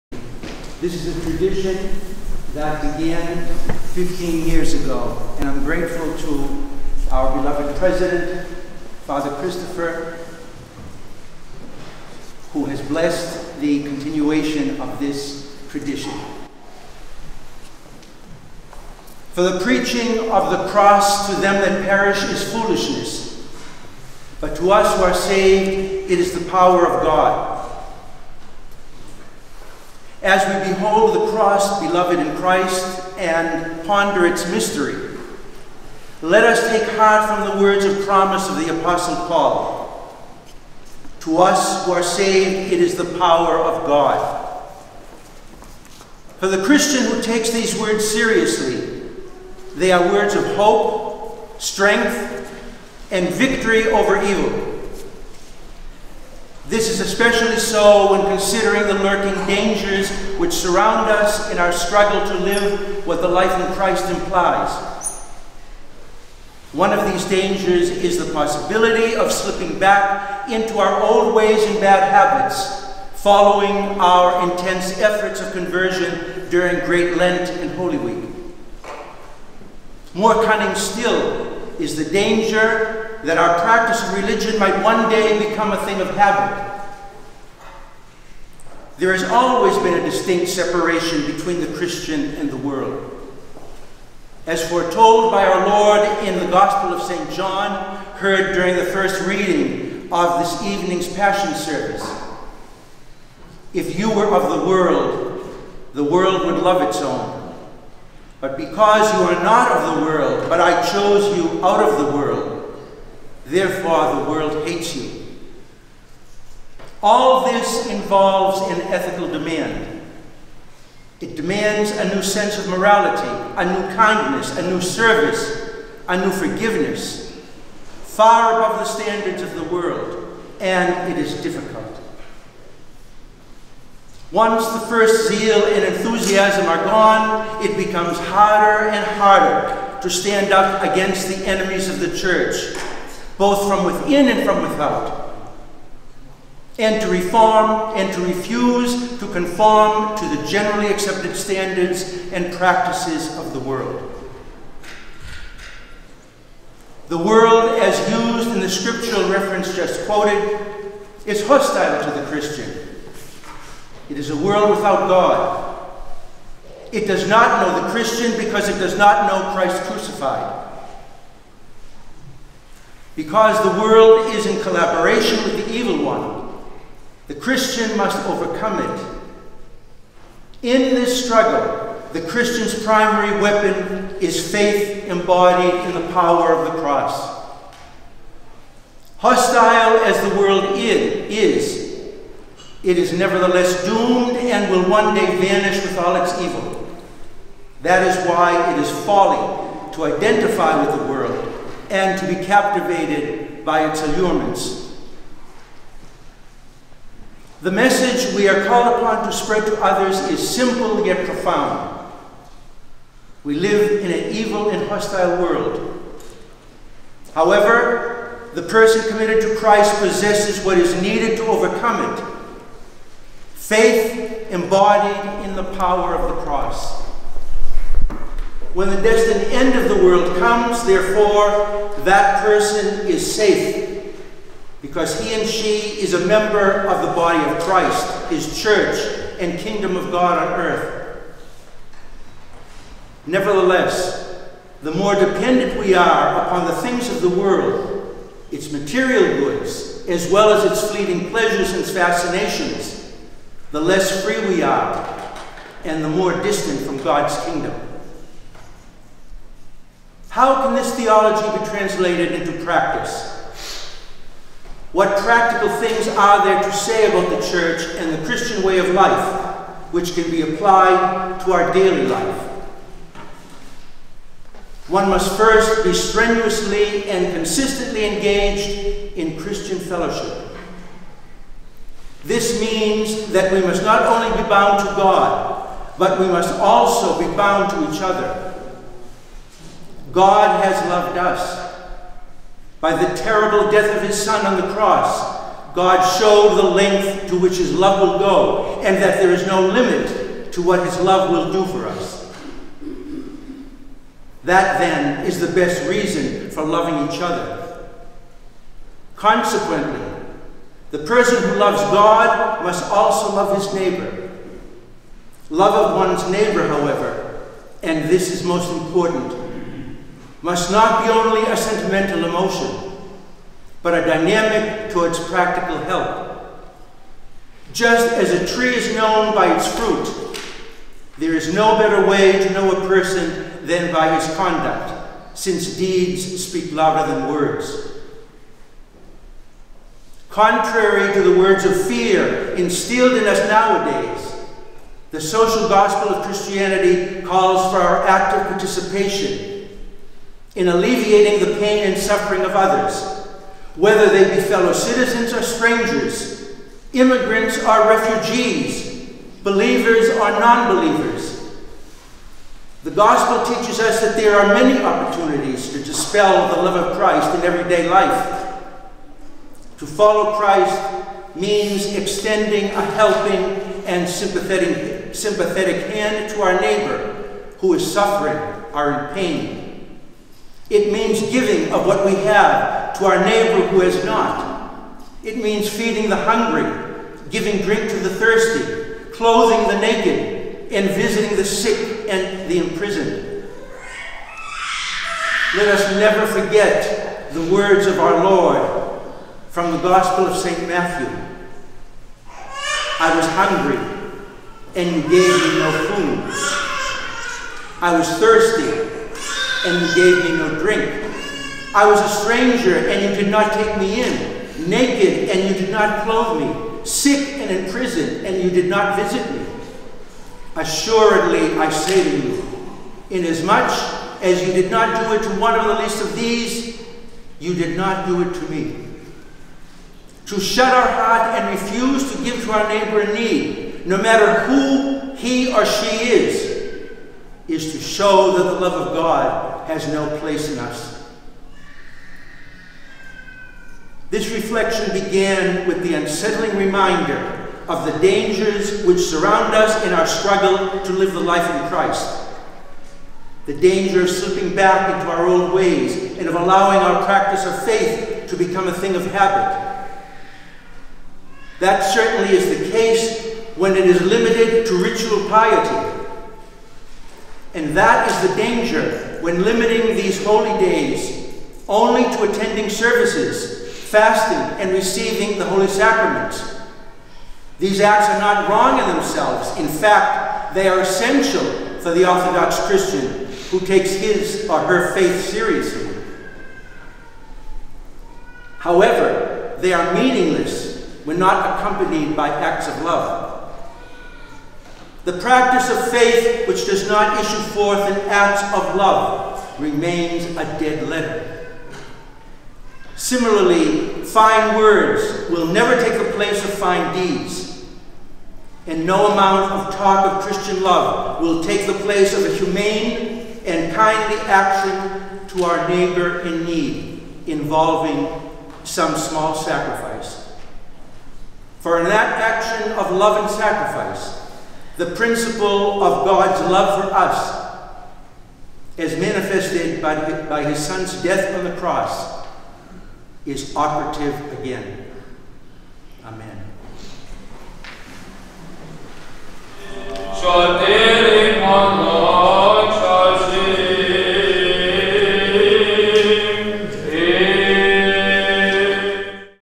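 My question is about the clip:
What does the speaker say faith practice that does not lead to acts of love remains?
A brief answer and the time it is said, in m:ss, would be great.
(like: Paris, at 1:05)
A dead letter, at 8:20.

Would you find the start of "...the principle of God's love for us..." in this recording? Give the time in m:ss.
8:44.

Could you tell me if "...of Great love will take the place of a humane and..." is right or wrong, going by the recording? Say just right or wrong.
wrong.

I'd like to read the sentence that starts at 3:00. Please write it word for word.
In this struggle, the Christian's primary weapon is faith embodied in the power of the cross.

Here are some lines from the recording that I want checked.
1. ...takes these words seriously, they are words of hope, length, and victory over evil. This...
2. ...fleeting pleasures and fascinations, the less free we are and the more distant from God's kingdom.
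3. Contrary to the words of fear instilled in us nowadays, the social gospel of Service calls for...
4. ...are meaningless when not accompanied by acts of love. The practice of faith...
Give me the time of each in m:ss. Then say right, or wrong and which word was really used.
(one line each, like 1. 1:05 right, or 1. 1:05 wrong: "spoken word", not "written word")
1. 0:47 wrong: "strength", not "length"
2. 4:10 right
3. 5:40 wrong: "Christianity", not "Service"
4. 8:09 right.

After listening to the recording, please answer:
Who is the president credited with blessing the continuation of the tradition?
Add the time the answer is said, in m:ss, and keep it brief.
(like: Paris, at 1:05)
Father Christopher, at 0:09.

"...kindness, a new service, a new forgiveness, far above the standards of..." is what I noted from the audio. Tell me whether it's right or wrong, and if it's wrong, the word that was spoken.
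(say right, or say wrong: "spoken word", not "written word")
right.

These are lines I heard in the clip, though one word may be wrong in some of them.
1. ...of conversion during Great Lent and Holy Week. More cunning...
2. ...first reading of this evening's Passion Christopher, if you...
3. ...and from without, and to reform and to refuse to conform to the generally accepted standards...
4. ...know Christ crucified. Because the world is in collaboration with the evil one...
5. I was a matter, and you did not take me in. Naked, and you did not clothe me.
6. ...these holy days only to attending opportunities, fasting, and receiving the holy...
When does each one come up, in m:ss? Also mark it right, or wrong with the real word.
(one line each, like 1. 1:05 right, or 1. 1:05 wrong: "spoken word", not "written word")
1. 1:15 right
2. 1:38 wrong: "Service", not "Christopher"
3. 2:24 right
4. 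2:49 right
5. 6:51 wrong: "stranger", not "matter"
6. 7:49 wrong: "services", not "opportunities".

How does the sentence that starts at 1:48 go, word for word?
But because you are not of the world, but I chose you out of the world, Therefore, the world hates you.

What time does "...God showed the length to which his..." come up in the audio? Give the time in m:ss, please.
4:55.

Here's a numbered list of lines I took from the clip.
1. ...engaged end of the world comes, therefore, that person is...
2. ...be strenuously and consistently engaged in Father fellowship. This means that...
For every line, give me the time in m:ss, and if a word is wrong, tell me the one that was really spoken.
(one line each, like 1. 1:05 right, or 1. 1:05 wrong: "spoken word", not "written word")
1. 3:49 wrong: "destined", not "engaged"
2. 4:35 wrong: "Christian", not "Father".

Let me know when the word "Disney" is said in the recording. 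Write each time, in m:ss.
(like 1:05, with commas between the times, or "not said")
not said.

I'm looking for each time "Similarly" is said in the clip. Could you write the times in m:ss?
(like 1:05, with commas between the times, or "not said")
8:22.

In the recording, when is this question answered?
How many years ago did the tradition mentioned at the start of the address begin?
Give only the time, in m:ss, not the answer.
0:03.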